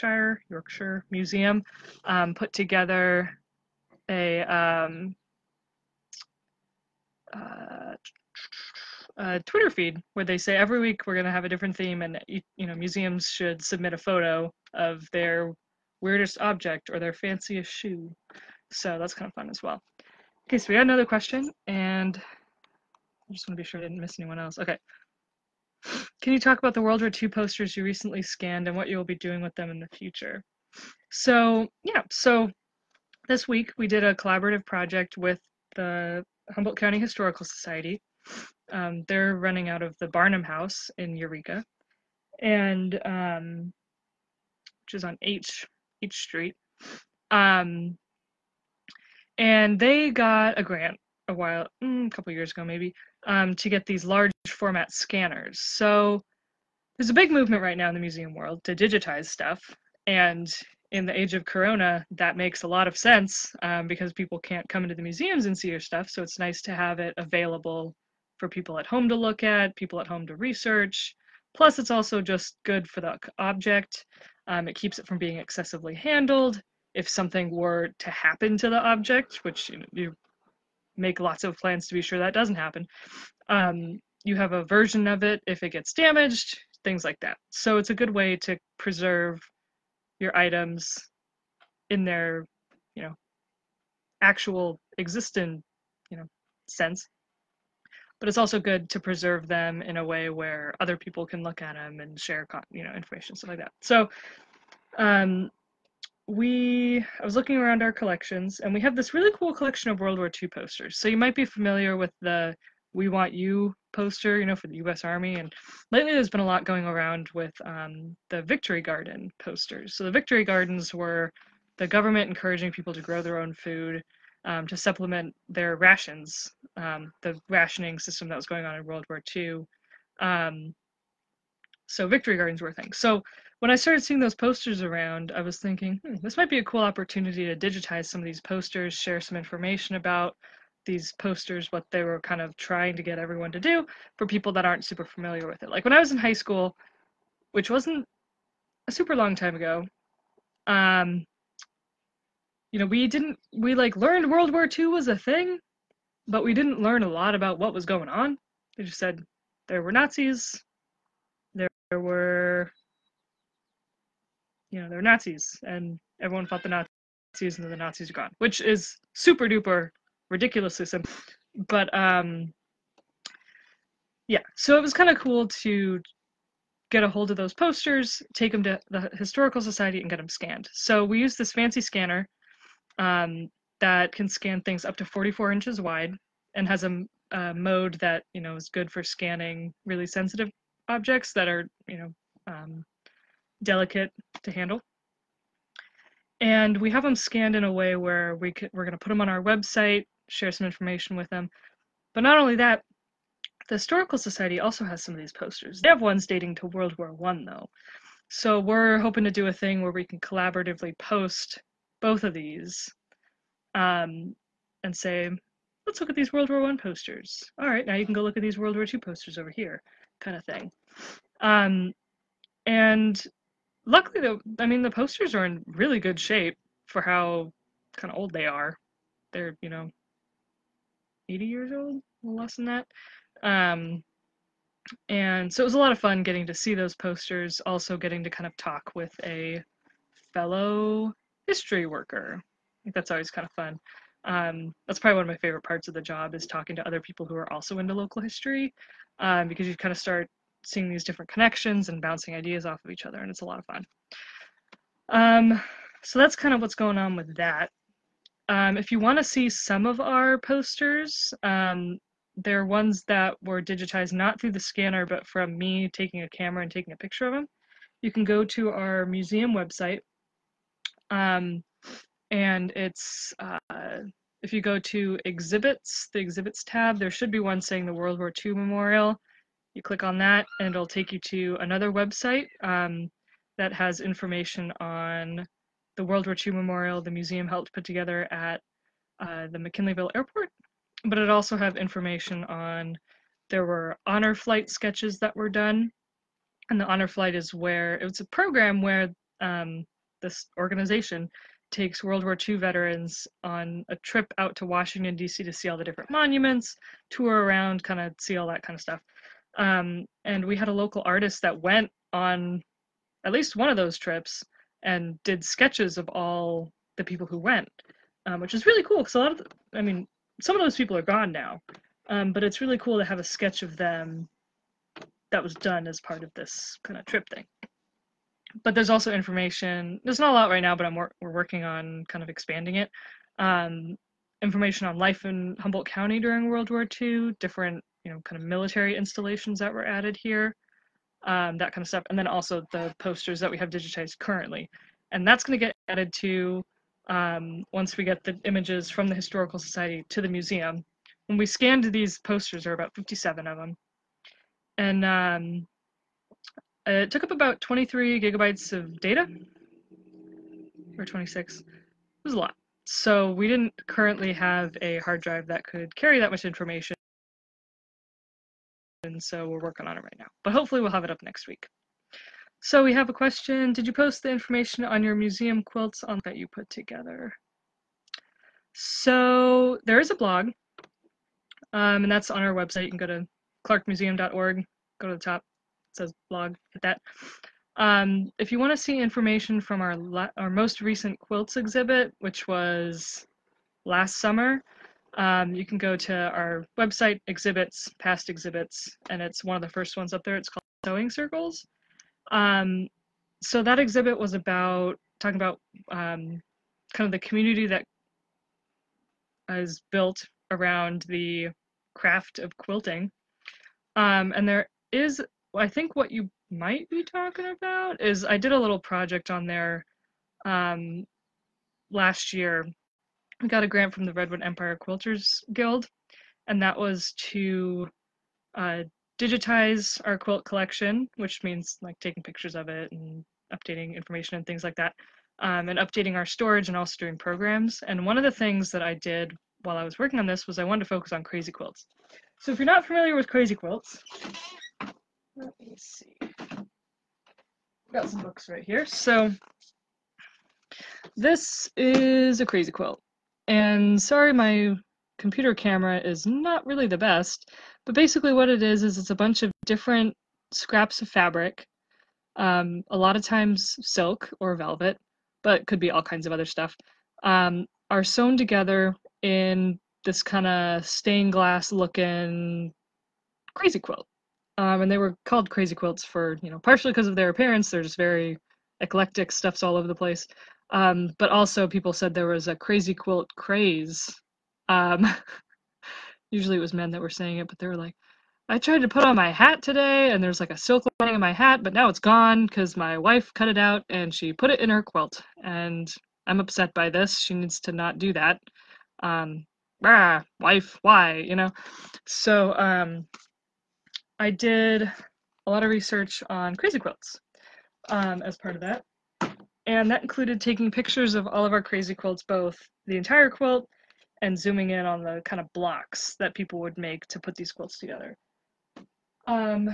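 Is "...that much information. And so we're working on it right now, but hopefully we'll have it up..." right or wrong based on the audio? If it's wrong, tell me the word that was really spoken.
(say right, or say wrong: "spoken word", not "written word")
right.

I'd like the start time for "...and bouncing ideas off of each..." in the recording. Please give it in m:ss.
4:11.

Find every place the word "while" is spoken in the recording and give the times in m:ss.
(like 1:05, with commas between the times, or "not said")
0:51, 7:19.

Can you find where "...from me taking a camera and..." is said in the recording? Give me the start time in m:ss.
4:25.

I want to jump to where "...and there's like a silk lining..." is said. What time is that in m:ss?
8:10.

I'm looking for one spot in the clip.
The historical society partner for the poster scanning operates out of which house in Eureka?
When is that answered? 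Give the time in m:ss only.
0:40.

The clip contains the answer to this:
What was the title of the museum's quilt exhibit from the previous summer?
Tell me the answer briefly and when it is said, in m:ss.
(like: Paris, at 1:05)
Sewing Circles, at 6:40.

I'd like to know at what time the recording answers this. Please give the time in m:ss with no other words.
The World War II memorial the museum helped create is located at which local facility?
4:49.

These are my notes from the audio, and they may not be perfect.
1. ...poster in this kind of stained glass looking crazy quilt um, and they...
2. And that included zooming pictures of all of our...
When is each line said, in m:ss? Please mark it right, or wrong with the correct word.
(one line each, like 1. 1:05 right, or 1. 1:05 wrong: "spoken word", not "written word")
1. 7:48 wrong: "together", not "poster"
2. 8:29 wrong: "taking", not "zooming".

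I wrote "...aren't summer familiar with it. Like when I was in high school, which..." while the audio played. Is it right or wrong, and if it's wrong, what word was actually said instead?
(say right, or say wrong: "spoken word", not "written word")
wrong: "super", not "summer".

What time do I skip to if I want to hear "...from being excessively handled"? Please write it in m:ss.
1:15.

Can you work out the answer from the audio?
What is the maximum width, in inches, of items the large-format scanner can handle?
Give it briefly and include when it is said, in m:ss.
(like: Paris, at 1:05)
44, at 3:05.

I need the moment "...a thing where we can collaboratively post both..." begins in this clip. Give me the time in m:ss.
3:29.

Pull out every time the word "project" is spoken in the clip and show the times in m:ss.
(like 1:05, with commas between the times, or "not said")
0:34, 6:58.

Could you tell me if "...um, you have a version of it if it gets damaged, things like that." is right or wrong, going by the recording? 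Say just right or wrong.
right.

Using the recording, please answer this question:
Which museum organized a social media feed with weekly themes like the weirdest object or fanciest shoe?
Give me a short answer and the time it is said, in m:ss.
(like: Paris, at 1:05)
Yorkshire Museum, at 0:00.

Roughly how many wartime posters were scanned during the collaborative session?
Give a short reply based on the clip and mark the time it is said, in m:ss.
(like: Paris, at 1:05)
57, at 5:52.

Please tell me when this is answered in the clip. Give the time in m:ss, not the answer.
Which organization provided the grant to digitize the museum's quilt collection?
7:04.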